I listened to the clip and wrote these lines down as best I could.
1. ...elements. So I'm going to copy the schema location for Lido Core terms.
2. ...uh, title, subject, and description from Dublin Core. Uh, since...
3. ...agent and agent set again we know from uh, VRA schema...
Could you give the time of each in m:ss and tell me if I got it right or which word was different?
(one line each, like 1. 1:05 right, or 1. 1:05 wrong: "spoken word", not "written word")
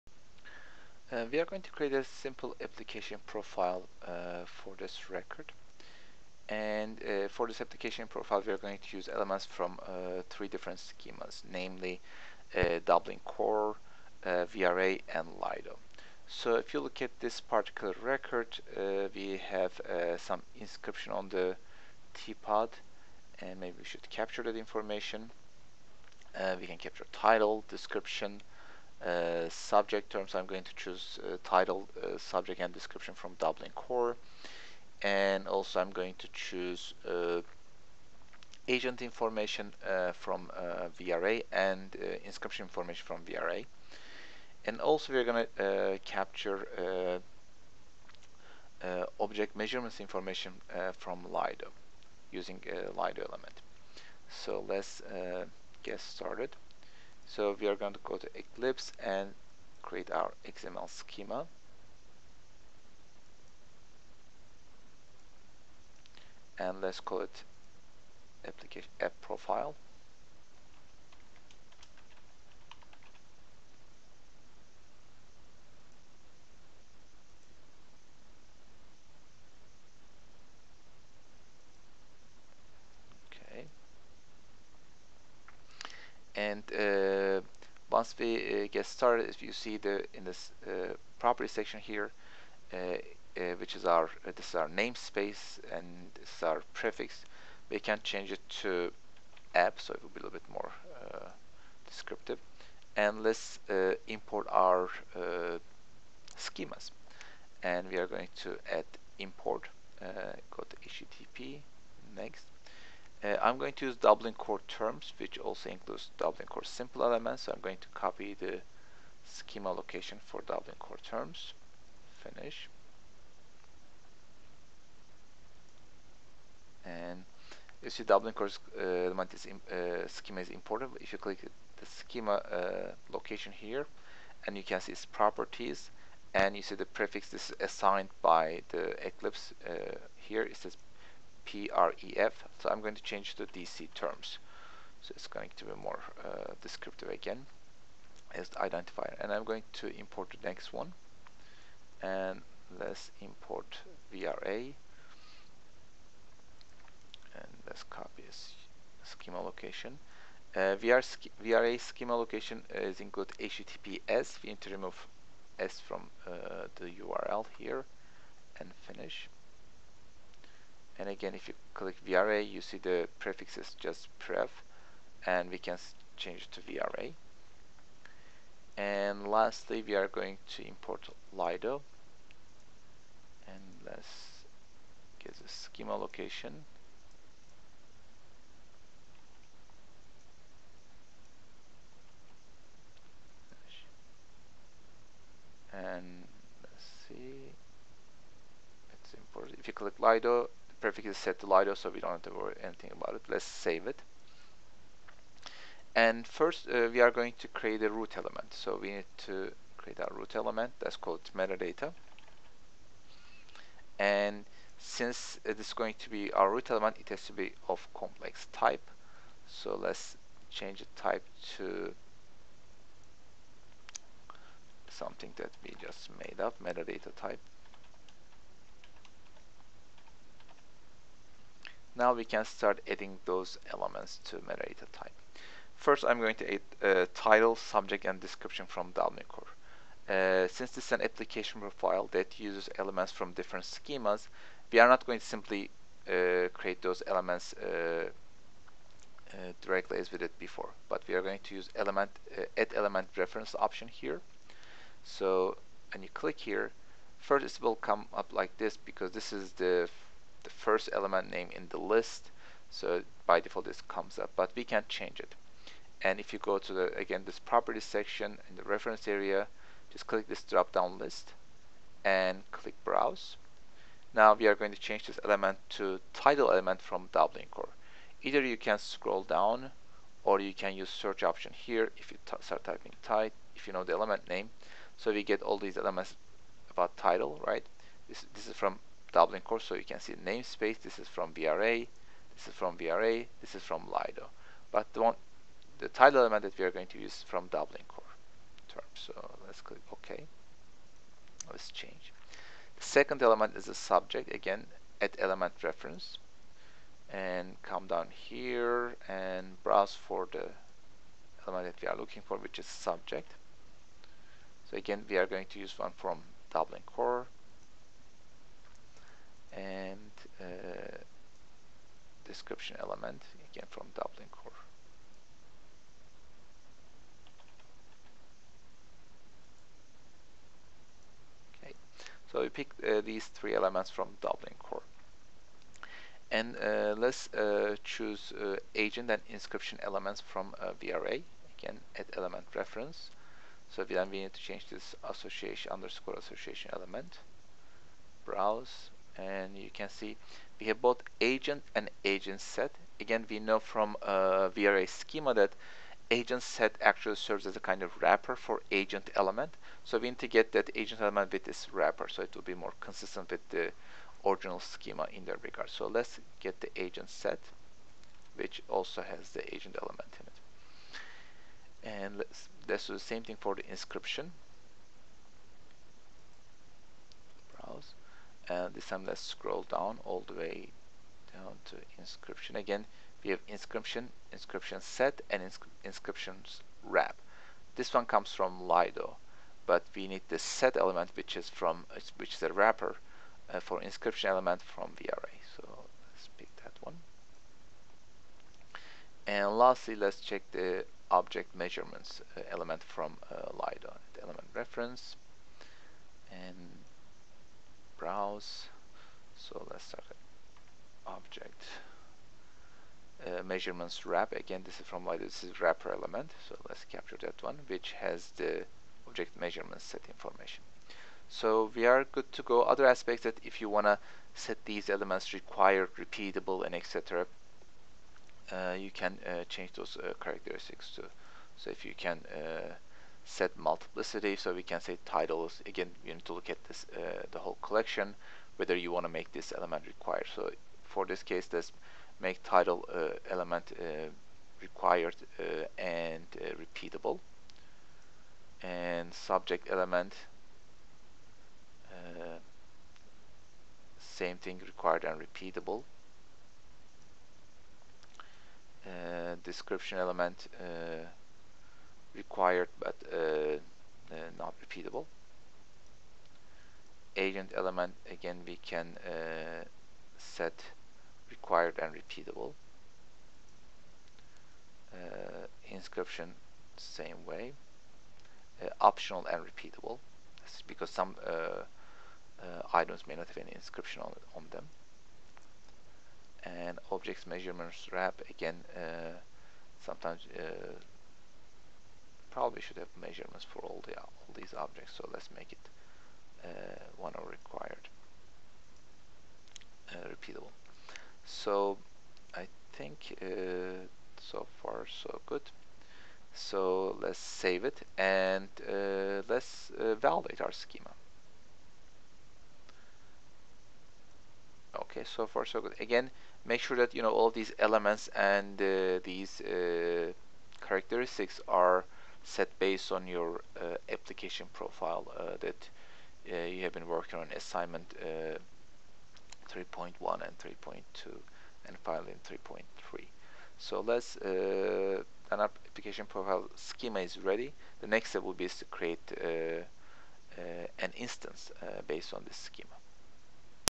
1. 1:57 wrong: "Dublin", not "Lido"
2. 3:56 right
3. 5:51 right.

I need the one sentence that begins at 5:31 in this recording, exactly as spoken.
Okay, so we picked uh, these three elements from Dublin core.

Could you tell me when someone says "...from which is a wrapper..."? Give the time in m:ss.
6:31.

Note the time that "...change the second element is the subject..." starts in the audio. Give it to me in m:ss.
5:01.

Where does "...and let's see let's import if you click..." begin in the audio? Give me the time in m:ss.
3:15.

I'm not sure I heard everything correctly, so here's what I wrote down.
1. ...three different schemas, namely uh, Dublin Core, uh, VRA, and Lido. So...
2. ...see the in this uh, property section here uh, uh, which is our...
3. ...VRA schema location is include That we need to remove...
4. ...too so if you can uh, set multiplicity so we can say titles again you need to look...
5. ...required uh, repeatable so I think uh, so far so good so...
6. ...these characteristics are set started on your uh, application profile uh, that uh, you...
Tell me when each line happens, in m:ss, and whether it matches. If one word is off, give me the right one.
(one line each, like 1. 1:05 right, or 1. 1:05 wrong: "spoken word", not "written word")
1. 0:10 right
2. 1:29 right
3. 2:41 wrong: "HTTPS", not "That"
4. 7:10 right
5. 8:17 right
6. 8:39 wrong: "based", not "started".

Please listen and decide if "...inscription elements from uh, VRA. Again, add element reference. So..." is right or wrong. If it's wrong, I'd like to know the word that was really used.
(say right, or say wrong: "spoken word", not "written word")
right.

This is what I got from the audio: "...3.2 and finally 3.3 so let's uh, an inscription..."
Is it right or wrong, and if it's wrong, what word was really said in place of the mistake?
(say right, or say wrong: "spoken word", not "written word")
wrong: "application", not "inscription".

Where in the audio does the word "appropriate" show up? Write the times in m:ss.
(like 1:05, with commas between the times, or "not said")
not said.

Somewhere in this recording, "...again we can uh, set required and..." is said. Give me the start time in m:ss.
7:48.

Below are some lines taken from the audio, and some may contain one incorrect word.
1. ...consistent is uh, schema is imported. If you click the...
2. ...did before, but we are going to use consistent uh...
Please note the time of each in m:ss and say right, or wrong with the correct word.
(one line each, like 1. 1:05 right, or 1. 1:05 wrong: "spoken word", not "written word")
1. 2:08 wrong: "element", not "consistent"
2. 4:10 wrong: "element", not "consistent".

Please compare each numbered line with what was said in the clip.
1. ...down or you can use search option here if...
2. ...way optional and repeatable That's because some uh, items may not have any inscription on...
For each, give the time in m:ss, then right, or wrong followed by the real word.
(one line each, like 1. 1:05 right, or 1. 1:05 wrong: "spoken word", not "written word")
1. 4:39 right
2. 7:57 right.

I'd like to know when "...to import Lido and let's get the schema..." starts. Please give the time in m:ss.
3:00.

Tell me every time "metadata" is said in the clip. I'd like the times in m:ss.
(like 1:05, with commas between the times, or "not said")
3:31, 3:46, 3:54.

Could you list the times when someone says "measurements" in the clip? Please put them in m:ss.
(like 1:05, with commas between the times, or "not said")
0:49, 6:41, 6:53, 6:59, 8:07, 8:12.